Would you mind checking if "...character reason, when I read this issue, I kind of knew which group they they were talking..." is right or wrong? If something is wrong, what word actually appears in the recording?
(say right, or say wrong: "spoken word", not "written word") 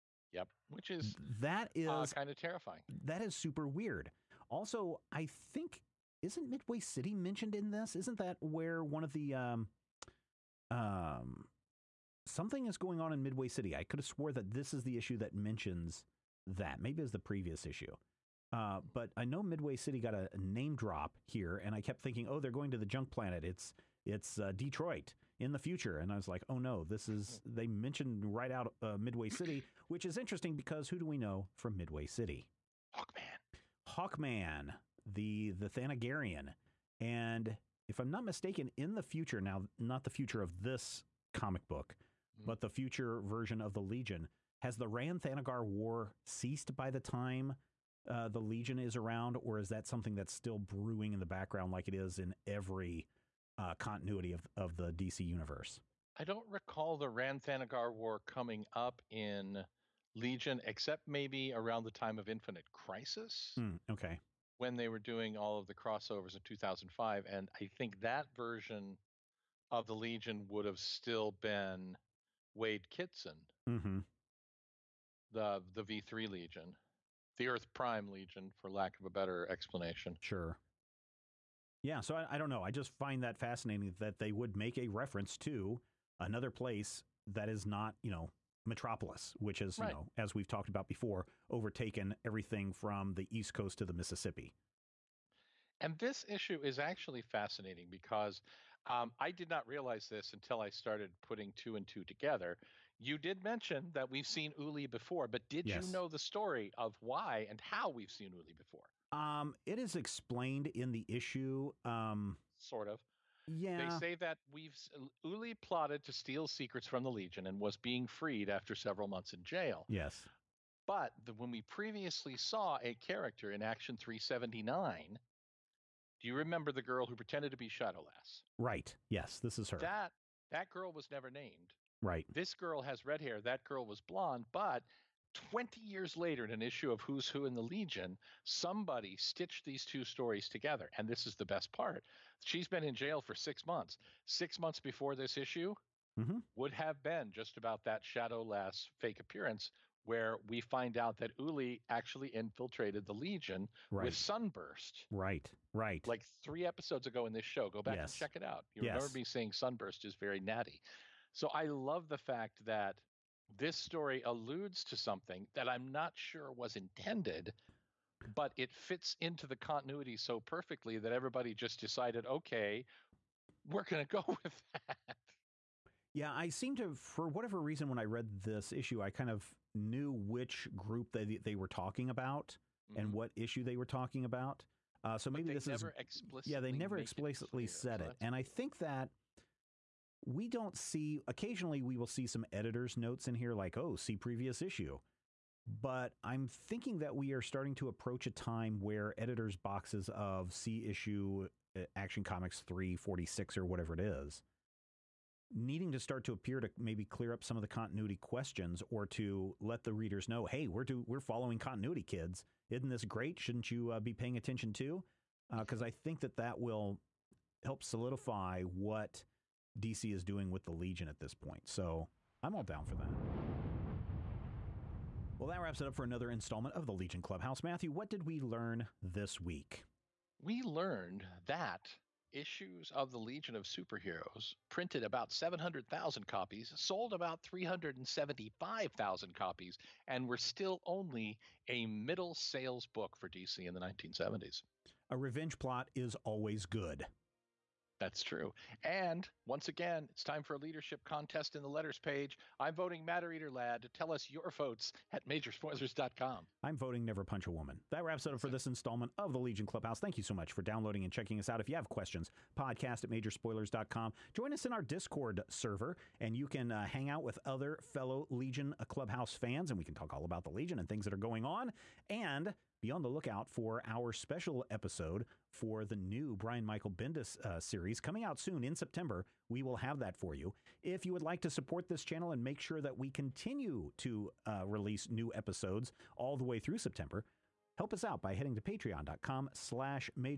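wrong: "whatever", not "character".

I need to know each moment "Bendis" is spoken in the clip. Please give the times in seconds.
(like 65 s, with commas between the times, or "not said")
276 s.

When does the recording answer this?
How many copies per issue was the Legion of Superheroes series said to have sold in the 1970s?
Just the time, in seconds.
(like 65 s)
237 s.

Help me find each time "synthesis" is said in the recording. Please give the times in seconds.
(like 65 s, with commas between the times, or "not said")
not said.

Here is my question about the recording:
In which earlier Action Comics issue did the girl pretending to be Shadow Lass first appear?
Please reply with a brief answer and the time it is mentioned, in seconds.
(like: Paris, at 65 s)
379, at 123 s.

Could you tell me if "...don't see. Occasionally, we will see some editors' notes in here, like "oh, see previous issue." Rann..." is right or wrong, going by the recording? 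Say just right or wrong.
wrong.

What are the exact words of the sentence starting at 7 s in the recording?
Isn't that where one of the um um something is going on in Midway City.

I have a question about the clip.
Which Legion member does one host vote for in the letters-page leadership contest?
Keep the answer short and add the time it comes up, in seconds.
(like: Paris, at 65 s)
Matter Eater Lad, at 253 s.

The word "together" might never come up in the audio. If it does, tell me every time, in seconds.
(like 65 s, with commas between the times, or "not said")
102 s, 140 s.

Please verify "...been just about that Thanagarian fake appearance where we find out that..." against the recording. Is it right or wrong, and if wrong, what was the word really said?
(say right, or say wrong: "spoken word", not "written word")
wrong: "Shadowlass", not "Thanagarian".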